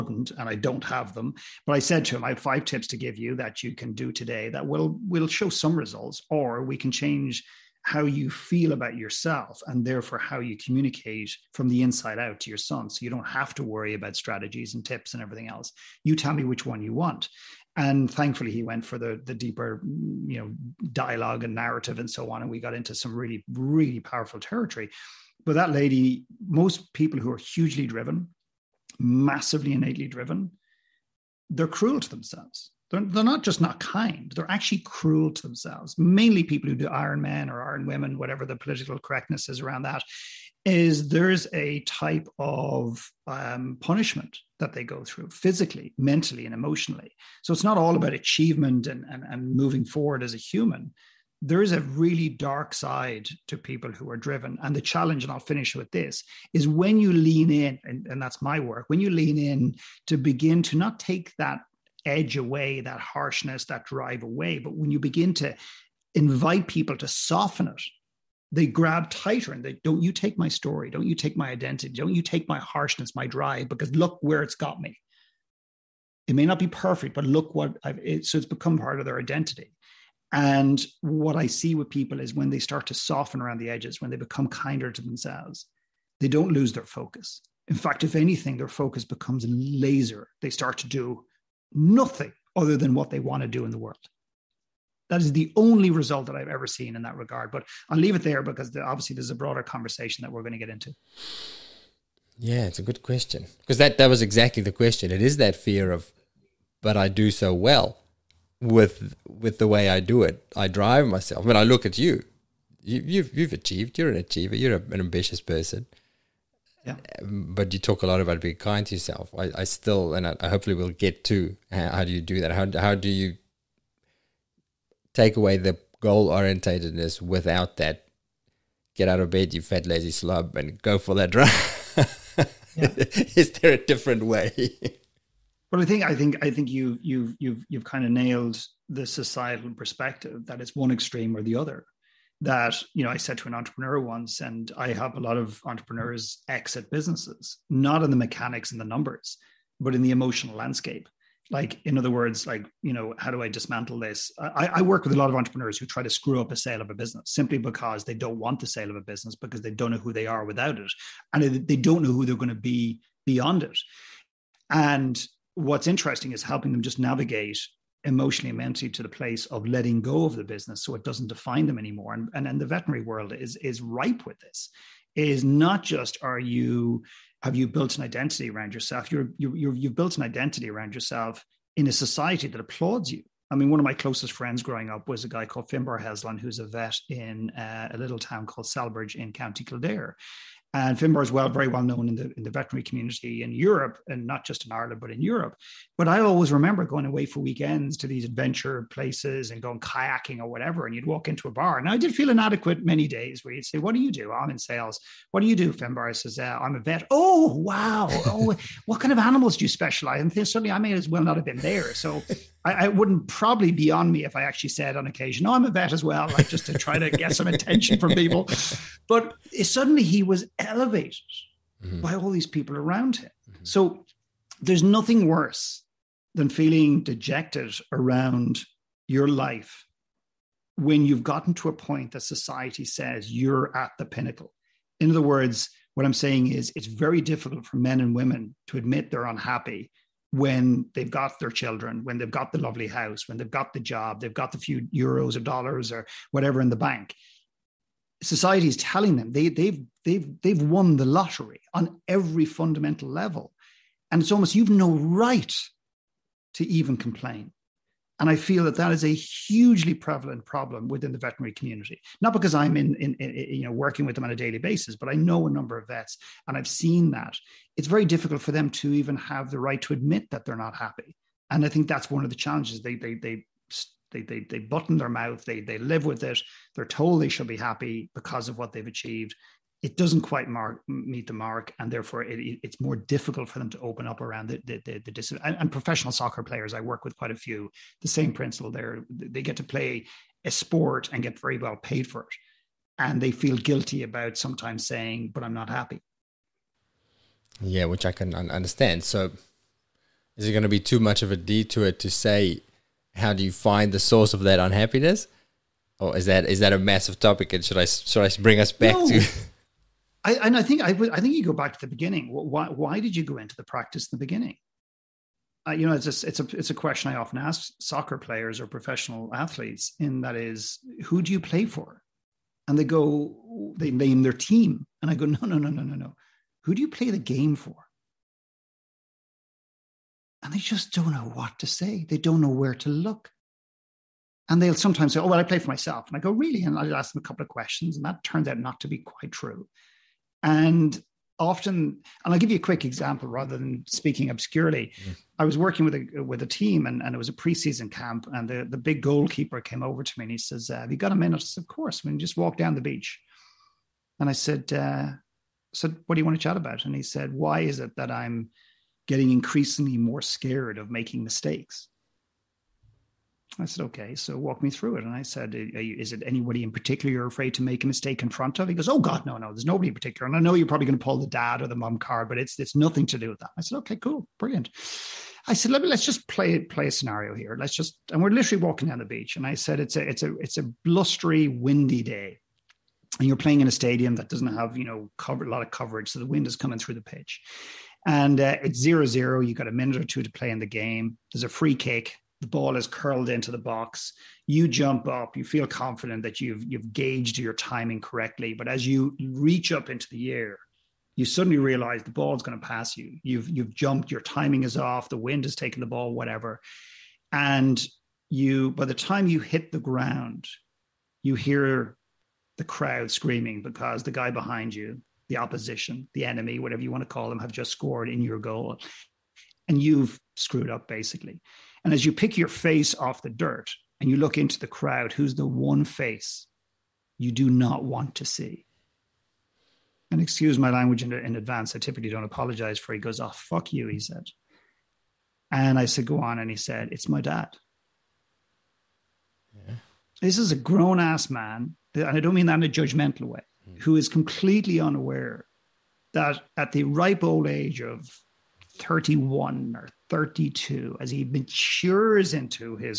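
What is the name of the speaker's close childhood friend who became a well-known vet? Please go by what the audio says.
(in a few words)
Finbar Heslan.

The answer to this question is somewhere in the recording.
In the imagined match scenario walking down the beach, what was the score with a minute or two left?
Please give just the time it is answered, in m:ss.
6:28.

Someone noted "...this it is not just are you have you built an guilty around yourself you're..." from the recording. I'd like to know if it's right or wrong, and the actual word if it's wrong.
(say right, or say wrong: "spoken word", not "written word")
wrong: "identity", not "guilty".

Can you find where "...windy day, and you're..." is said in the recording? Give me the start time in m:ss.
6:21.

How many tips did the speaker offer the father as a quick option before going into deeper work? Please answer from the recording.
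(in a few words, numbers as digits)
5.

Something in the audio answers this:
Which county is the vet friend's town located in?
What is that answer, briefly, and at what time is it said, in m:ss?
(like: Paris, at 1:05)
Kildare, at 3:09.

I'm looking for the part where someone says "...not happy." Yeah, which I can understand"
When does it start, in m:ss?
4:55.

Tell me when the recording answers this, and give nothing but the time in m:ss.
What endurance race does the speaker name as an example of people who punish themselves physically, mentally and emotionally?
0:36.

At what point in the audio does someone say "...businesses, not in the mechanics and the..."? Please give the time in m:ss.
2:26.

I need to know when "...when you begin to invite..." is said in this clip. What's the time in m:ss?
1:04.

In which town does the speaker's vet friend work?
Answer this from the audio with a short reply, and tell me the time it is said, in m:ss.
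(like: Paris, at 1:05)
Celbridge, at 3:08.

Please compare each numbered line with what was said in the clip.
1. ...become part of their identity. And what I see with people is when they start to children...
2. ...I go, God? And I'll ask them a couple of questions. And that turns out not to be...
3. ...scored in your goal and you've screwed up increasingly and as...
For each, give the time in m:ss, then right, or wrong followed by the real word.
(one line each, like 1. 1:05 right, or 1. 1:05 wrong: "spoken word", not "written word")
1. 1:18 wrong: "soften", not "children"
2. 5:36 wrong: "Really", not "God"
3. 6:57 wrong: "basically", not "increasingly".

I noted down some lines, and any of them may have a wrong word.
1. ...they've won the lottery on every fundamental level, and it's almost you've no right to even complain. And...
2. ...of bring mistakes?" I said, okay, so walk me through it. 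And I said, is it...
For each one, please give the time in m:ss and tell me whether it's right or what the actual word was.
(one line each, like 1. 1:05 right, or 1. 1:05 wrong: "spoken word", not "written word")
1. 4:10 right
2. 6:00 wrong: "making", not "bring".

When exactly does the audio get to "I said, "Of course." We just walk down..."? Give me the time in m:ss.
5:51.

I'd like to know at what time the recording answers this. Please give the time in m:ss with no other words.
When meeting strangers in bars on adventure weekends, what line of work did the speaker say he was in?
3:24.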